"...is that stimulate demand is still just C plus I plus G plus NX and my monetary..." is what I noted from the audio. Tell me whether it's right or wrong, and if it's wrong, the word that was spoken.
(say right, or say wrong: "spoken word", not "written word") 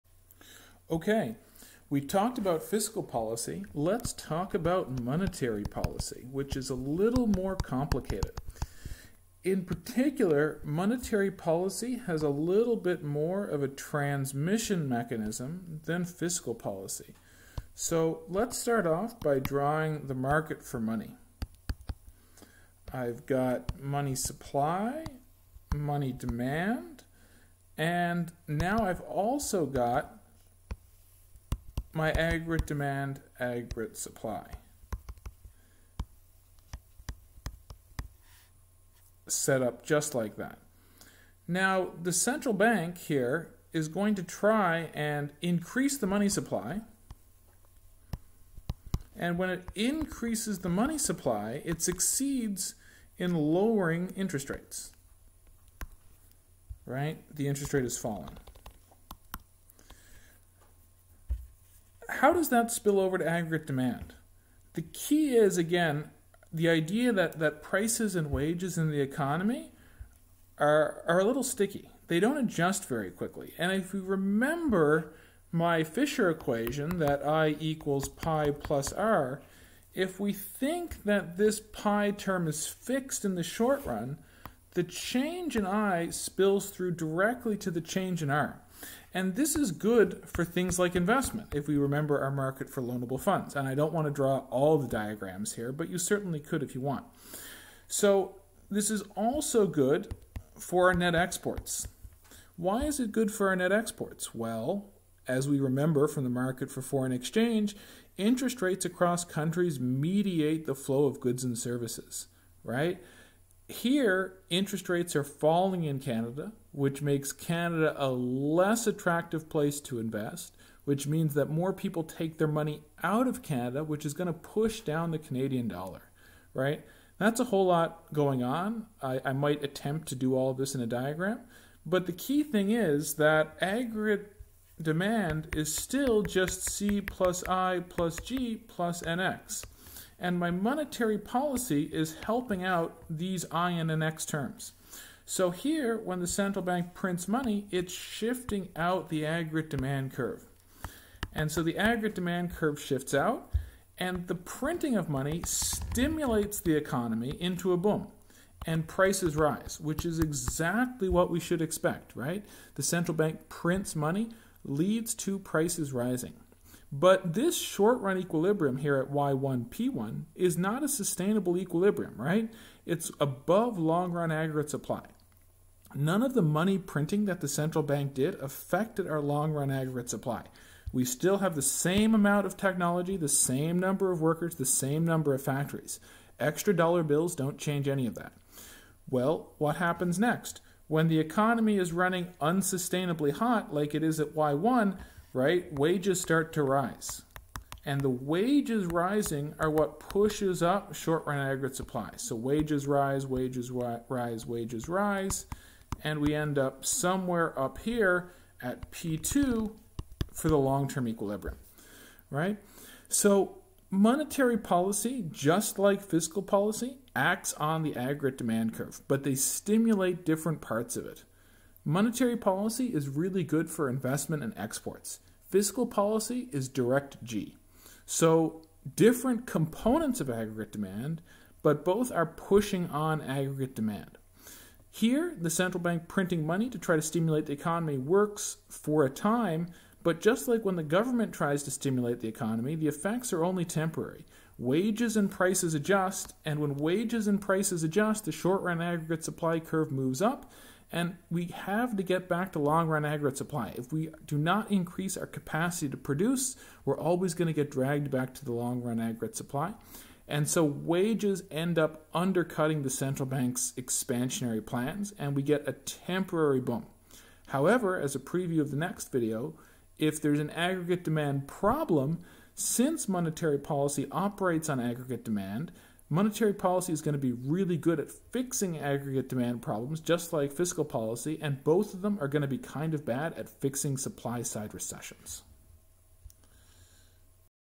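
wrong: "aggregate", not "stimulate".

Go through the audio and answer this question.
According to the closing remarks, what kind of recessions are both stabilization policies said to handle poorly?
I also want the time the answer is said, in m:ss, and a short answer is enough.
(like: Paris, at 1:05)
supply side recessions, at 4:43.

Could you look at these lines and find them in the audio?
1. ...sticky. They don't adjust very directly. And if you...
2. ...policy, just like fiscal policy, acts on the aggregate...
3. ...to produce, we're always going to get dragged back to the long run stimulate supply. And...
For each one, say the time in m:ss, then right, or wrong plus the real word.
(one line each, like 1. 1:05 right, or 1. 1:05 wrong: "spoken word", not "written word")
1. 1:11 wrong: "quickly", not "directly"
2. 3:34 right
3. 4:15 wrong: "aggregate", not "stimulate".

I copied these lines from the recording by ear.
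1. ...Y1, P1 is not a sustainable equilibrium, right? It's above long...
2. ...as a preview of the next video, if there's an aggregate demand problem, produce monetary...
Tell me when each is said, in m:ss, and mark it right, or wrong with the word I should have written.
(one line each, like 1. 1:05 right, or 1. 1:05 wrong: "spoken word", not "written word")
1. 2:49 right
2. 4:27 wrong: "since", not "produce".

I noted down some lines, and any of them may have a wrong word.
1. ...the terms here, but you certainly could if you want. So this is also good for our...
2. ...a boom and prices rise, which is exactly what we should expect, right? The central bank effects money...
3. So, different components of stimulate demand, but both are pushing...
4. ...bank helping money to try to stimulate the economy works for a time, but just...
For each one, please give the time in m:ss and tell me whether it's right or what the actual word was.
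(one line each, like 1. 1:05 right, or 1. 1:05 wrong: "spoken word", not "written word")
1. 1:34 wrong: "diagrams", not "terms"
2. 2:37 wrong: "prints", not "effects"
3. 3:48 wrong: "aggregate", not "stimulate"
4. 3:55 wrong: "printing", not "helping".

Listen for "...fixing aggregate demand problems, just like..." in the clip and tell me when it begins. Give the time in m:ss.
4:38.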